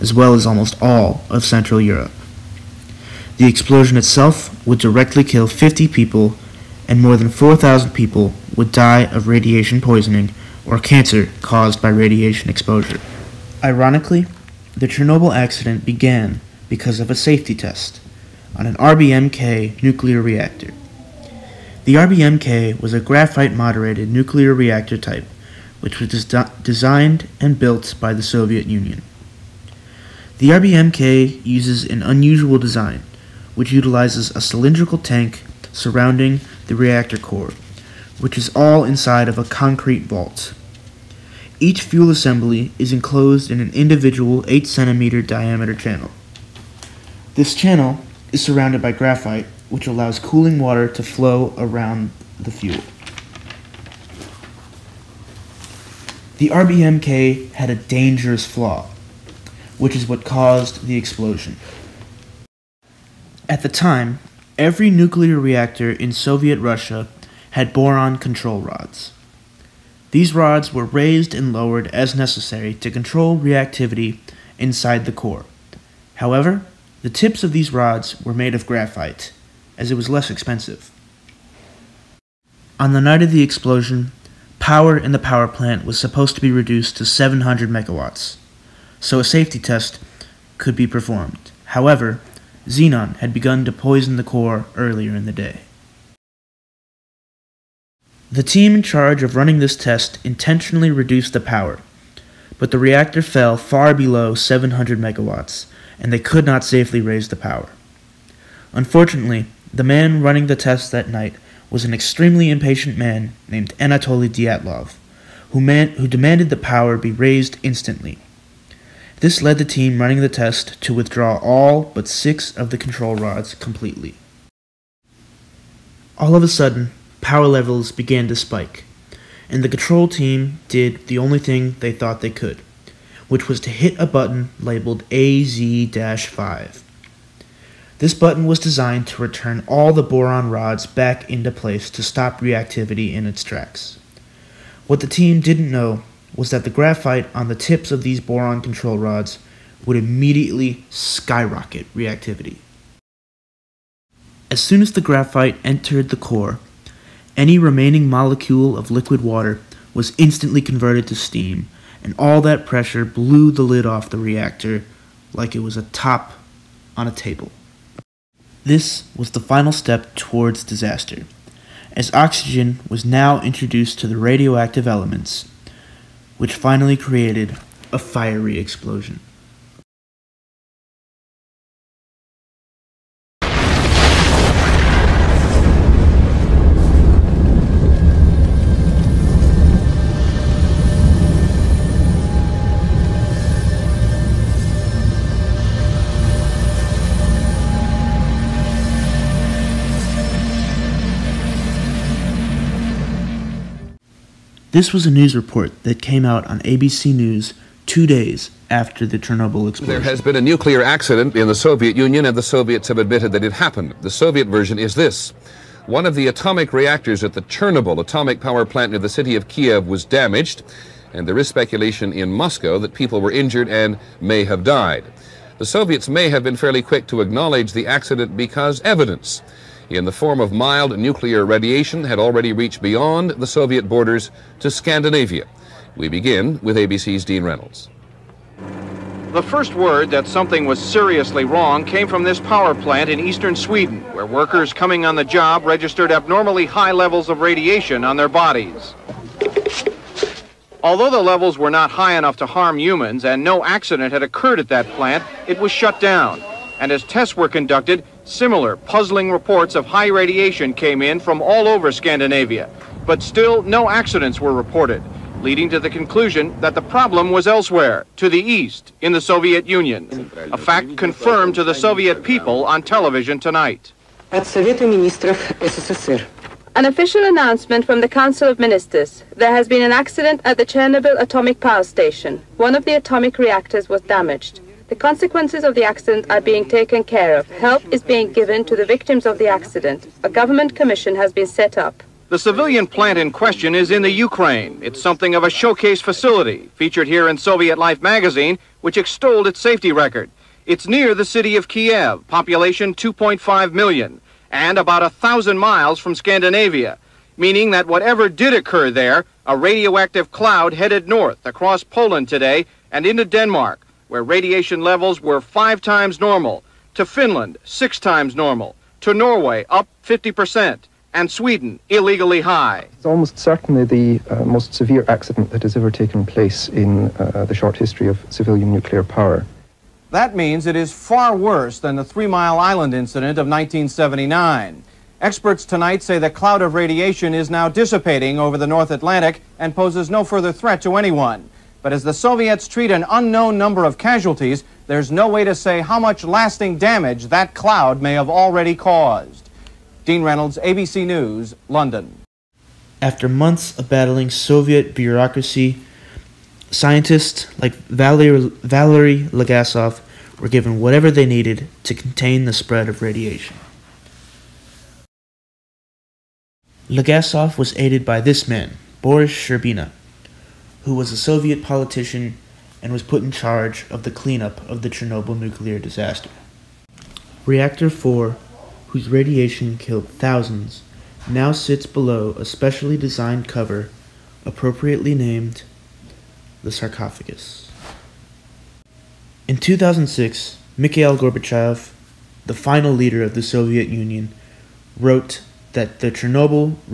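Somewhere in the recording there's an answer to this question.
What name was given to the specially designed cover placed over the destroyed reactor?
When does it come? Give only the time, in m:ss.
6:26.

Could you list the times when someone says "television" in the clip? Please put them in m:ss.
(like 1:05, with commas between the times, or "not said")
4:32.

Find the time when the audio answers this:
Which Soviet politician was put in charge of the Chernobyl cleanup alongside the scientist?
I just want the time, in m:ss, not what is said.
6:09.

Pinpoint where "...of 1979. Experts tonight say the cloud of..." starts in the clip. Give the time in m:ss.
5:33.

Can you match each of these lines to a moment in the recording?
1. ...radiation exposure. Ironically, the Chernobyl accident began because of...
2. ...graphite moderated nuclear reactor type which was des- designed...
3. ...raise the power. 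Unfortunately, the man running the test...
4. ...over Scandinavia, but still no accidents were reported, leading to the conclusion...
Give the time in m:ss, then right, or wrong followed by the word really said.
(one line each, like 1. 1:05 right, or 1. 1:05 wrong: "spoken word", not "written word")
1. 0:11 right
2. 0:23 right
3. 1:46 right
4. 4:21 right.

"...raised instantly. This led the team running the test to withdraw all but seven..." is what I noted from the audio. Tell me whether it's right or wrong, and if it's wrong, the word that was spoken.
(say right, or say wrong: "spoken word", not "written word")
wrong: "six", not "seven".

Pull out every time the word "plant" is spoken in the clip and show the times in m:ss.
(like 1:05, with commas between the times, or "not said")
1:25, 3:38, 4:02, 4:14, 4:52.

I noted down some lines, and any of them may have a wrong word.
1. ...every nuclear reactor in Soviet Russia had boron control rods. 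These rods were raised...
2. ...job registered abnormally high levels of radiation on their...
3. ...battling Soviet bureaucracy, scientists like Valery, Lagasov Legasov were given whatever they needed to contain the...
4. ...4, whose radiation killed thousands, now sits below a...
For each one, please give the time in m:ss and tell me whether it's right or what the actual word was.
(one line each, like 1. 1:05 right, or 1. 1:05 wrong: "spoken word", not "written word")
1. 1:04 right
2. 4:05 right
3. 5:53 right
4. 6:17 right.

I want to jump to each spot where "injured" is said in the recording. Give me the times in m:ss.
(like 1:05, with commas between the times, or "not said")
3:43.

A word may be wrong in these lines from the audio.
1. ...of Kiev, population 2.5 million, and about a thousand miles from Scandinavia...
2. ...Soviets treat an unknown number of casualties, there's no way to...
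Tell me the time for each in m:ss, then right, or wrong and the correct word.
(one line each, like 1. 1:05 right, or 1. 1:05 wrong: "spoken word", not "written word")
1. 5:01 right
2. 5:42 right.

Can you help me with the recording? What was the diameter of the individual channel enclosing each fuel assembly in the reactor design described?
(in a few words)
8 cm.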